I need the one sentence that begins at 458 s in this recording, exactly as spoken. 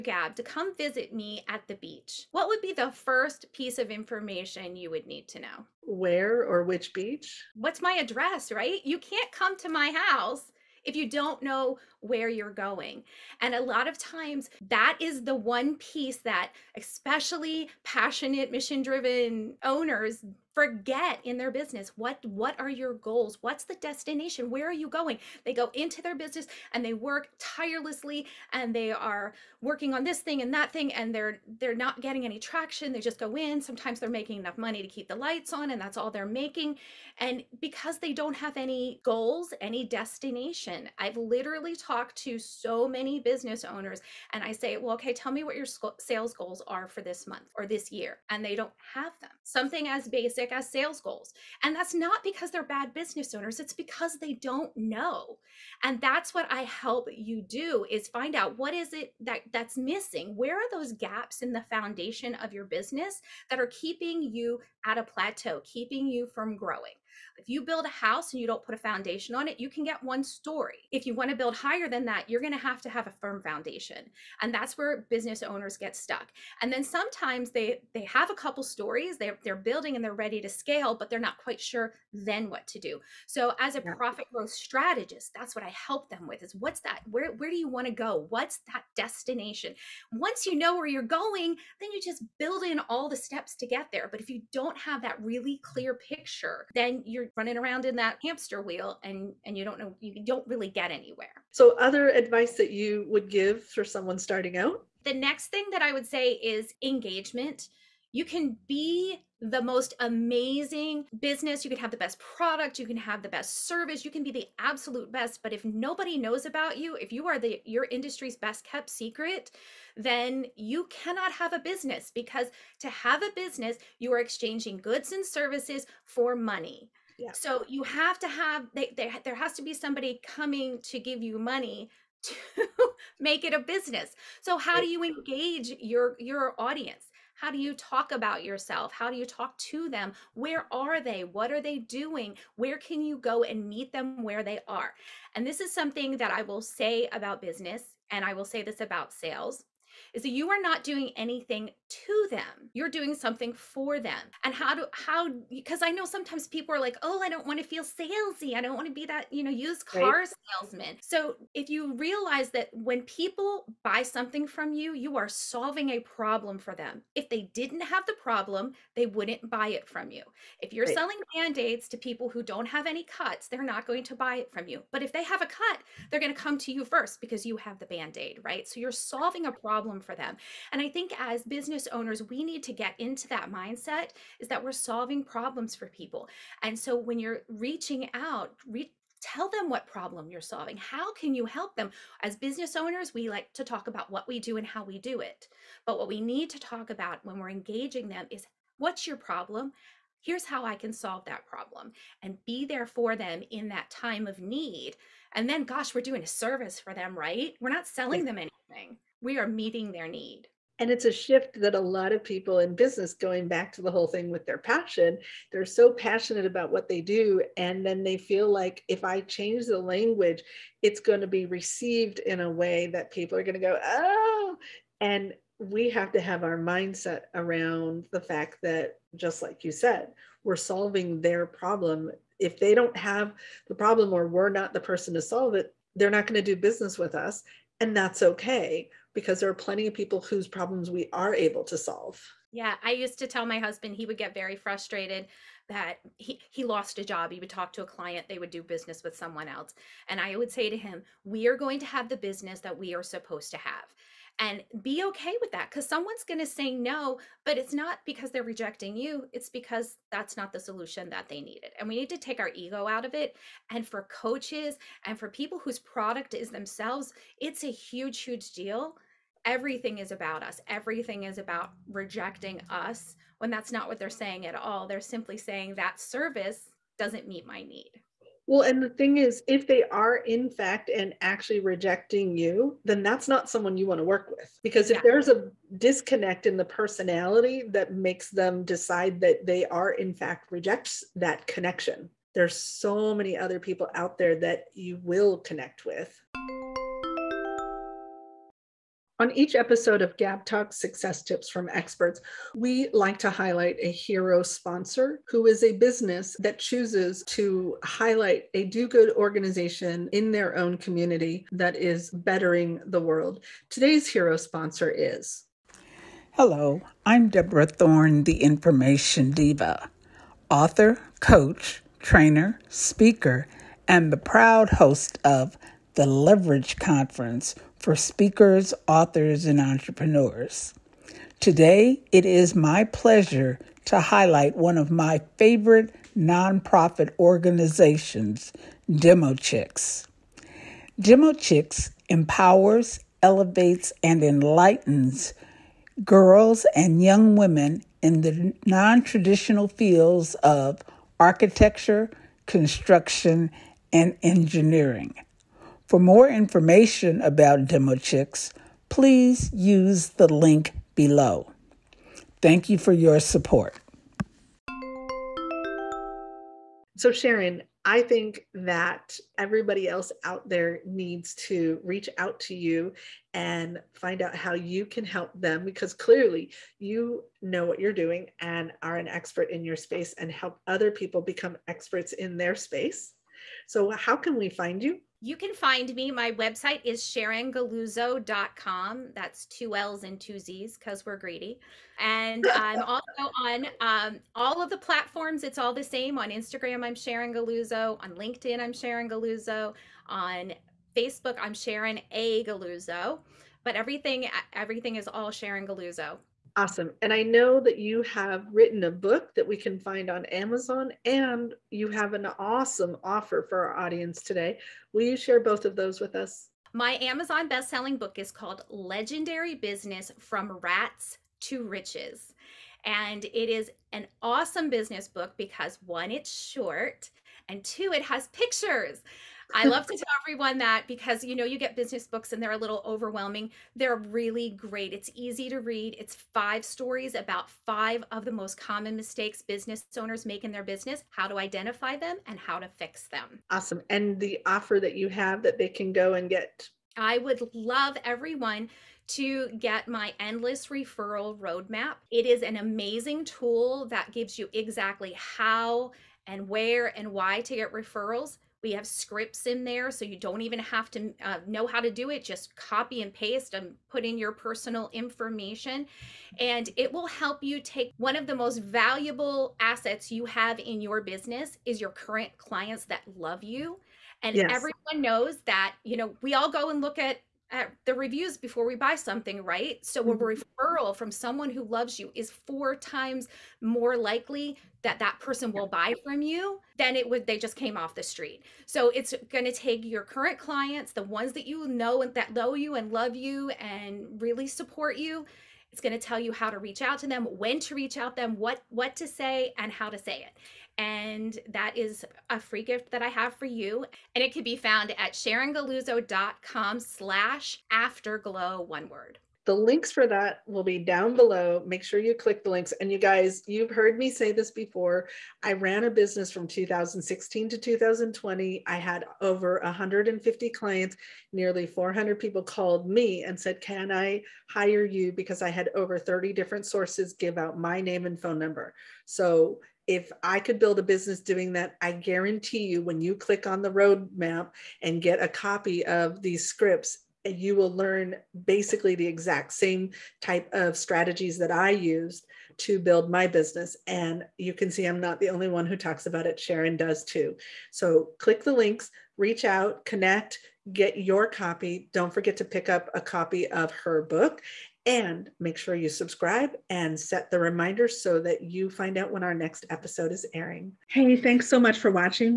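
We have scripts in there, so you don't even have to uh, know how to do it.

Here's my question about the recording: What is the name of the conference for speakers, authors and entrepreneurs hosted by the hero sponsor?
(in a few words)
Leverage Conference.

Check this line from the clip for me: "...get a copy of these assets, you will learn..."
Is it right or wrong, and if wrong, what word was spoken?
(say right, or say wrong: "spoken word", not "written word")
wrong: "scripts", not "assets".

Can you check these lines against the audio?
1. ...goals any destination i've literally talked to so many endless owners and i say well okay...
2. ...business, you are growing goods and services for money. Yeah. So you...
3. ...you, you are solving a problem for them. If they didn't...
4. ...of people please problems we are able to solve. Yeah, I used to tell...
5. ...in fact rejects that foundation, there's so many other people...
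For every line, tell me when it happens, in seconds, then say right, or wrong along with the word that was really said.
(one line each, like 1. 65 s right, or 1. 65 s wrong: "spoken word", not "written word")
1. 39 s wrong: "business", not "endless"
2. 123 s wrong: "exchanging", not "growing"
3. 164 s right
4. 239 s wrong: "whose", not "please"
5. 289 s wrong: "connection", not "foundation".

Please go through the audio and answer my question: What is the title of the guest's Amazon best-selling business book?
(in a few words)
Legendary Business from Rats to Riches.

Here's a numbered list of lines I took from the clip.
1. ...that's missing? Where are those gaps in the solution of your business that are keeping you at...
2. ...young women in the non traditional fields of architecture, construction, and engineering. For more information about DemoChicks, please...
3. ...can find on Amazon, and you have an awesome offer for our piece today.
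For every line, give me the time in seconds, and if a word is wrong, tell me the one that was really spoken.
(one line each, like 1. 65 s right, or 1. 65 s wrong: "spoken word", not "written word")
1. 59 s wrong: "foundation", not "solution"
2. 347 s right
3. 409 s wrong: "audience", not "piece".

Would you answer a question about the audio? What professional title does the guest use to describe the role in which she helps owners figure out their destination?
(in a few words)
profit growth strategist.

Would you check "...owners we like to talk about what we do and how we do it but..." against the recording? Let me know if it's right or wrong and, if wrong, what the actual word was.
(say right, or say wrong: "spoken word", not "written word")
right.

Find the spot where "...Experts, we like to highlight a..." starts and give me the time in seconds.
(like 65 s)
301 s.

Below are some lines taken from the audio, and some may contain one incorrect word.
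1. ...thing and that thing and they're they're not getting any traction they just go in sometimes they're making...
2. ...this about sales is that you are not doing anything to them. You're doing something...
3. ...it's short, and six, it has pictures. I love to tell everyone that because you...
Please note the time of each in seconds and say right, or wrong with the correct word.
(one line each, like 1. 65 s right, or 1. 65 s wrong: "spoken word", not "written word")
1. 30 s right
2. 148 s right
3. 426 s wrong: "two", not "six".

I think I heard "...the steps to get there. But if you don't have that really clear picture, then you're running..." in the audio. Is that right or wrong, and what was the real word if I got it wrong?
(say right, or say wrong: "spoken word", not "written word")
right.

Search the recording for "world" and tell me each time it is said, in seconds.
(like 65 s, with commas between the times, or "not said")
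313 s.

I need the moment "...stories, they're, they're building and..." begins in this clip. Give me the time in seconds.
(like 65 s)
78 s.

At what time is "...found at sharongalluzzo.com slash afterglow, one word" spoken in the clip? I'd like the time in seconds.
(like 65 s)
504 s.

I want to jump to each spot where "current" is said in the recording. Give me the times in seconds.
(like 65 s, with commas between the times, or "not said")
471 s, 490 s.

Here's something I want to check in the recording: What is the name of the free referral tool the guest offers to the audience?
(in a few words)
Endless Referral Roadmap.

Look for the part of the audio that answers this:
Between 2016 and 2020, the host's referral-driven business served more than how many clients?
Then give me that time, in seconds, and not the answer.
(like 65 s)
519 s.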